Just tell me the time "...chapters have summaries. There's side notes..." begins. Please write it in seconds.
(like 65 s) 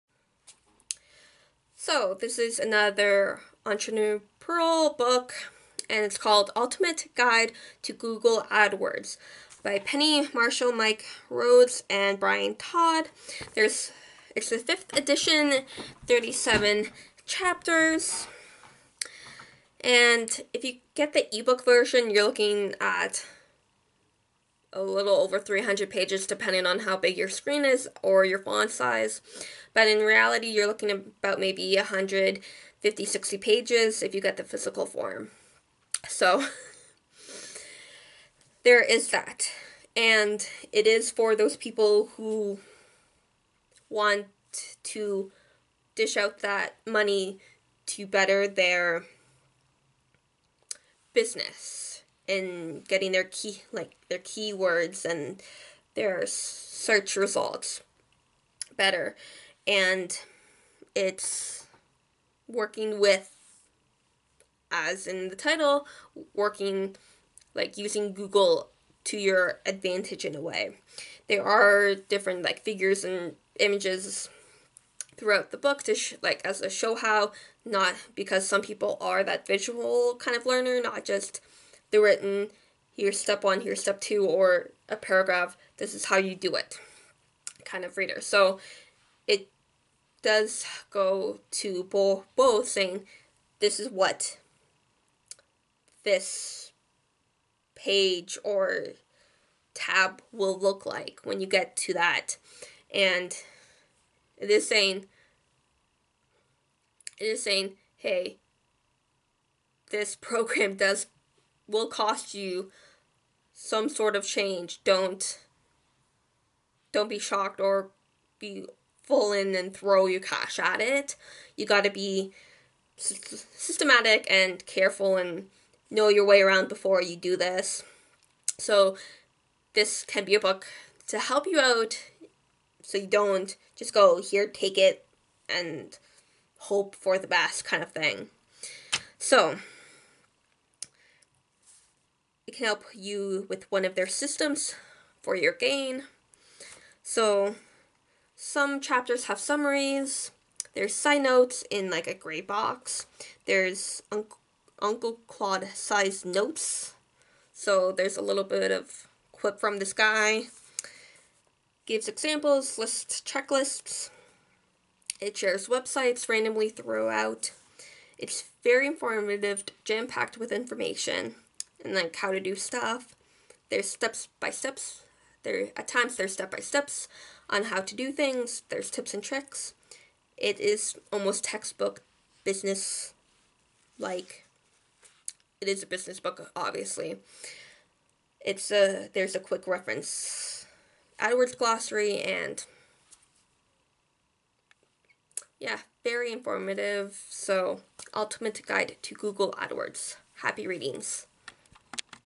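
148 s.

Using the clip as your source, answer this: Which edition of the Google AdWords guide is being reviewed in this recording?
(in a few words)
fifth.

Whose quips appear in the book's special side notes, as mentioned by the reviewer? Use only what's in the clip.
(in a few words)
Uncle Claude.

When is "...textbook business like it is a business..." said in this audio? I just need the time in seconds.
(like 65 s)
181 s.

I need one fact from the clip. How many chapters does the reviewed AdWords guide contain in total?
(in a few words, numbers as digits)
37.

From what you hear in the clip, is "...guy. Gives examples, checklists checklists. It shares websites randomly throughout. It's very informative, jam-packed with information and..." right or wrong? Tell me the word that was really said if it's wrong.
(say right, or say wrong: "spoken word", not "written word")
wrong: "lists", not "checklists".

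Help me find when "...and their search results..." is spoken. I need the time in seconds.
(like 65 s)
55 s.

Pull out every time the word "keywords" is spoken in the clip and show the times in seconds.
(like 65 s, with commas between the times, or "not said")
54 s.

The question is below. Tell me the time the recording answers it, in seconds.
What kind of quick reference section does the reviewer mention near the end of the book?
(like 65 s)
191 s.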